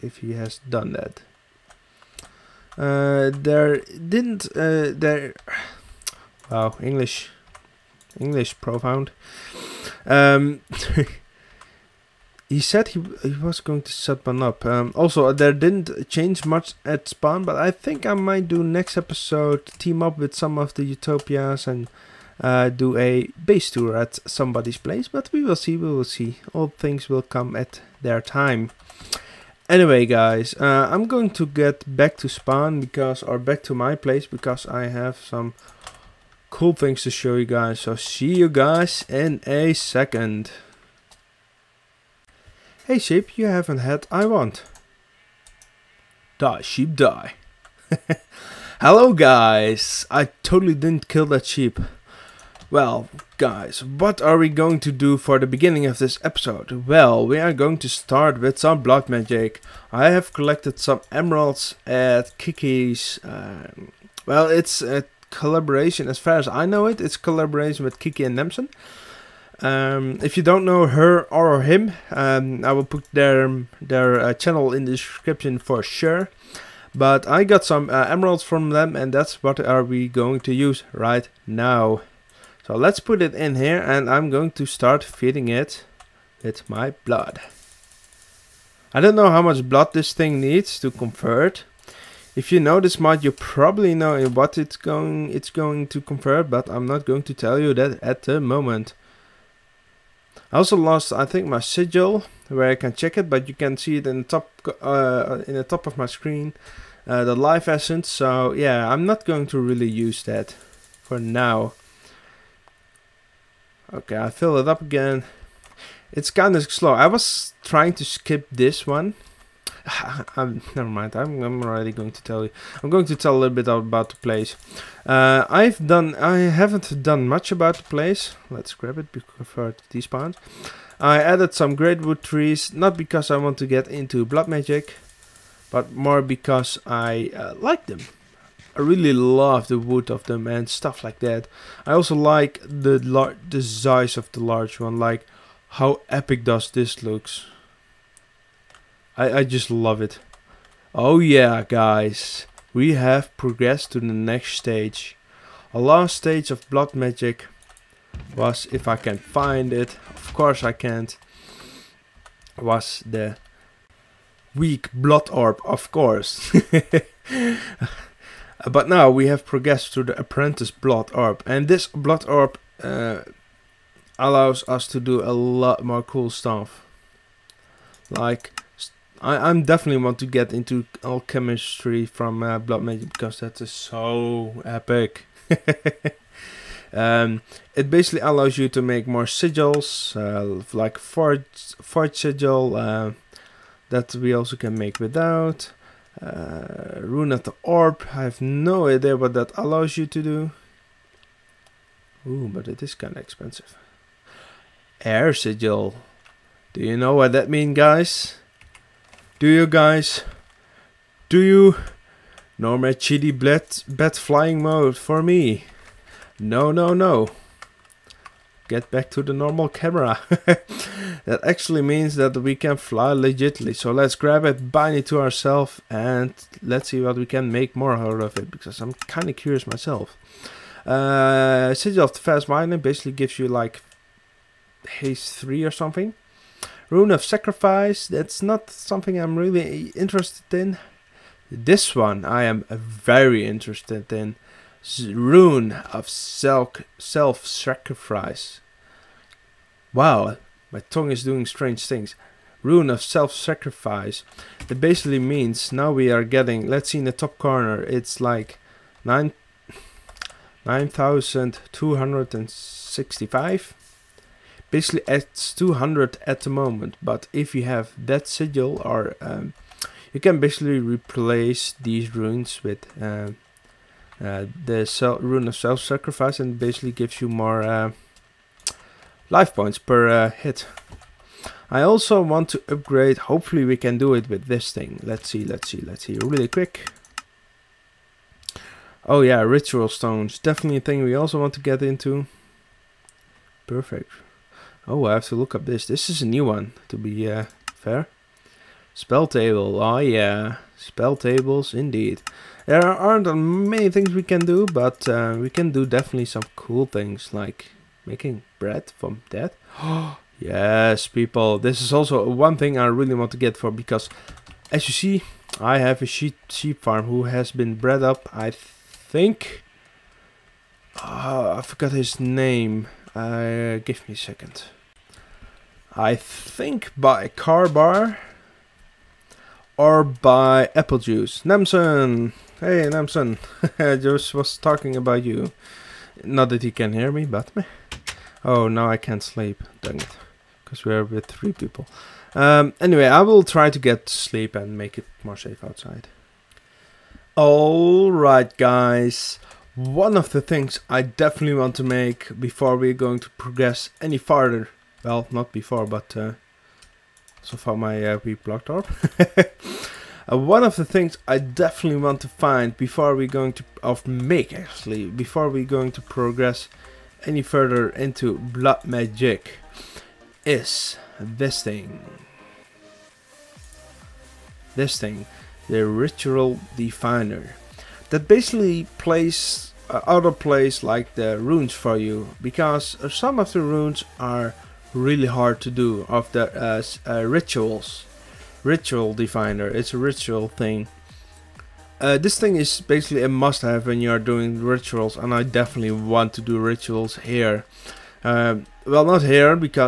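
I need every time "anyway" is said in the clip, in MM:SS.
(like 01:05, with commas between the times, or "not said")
00:29, 05:42.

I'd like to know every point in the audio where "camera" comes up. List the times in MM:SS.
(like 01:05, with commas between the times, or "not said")
03:39.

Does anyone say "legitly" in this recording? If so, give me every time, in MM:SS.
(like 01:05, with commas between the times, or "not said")
03:43.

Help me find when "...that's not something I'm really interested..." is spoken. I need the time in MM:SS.
03:58.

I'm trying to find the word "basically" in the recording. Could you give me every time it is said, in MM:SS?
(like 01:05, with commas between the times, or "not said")
03:07, 03:52, 04:14, 04:24, 04:30, 04:36, 06:18, 06:32.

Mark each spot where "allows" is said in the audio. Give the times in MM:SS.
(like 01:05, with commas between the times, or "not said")
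02:54, 03:08, 03:19.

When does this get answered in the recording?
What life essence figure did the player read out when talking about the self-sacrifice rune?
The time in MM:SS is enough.
04:19.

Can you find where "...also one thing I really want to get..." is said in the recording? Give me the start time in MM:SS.
05:11.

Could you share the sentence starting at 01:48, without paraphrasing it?
So yeah, I'm not going to really use that for now.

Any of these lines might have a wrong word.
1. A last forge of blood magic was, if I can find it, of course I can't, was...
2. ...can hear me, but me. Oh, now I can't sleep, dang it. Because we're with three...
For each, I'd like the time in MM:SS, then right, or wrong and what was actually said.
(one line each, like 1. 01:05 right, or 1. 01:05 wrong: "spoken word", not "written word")
1. 02:35 wrong: "stage", not "forge"
2. 05:36 right.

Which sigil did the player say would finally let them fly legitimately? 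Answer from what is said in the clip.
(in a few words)
Air sigil.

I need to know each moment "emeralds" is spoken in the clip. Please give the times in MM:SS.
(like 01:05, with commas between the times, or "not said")
01:01, 01:18.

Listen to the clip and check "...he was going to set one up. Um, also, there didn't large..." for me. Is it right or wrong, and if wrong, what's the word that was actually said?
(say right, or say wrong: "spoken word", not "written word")
wrong: "change", not "large".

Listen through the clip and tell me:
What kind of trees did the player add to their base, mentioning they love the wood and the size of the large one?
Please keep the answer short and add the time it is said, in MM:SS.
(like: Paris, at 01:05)
Greatwood trees, at 02:11.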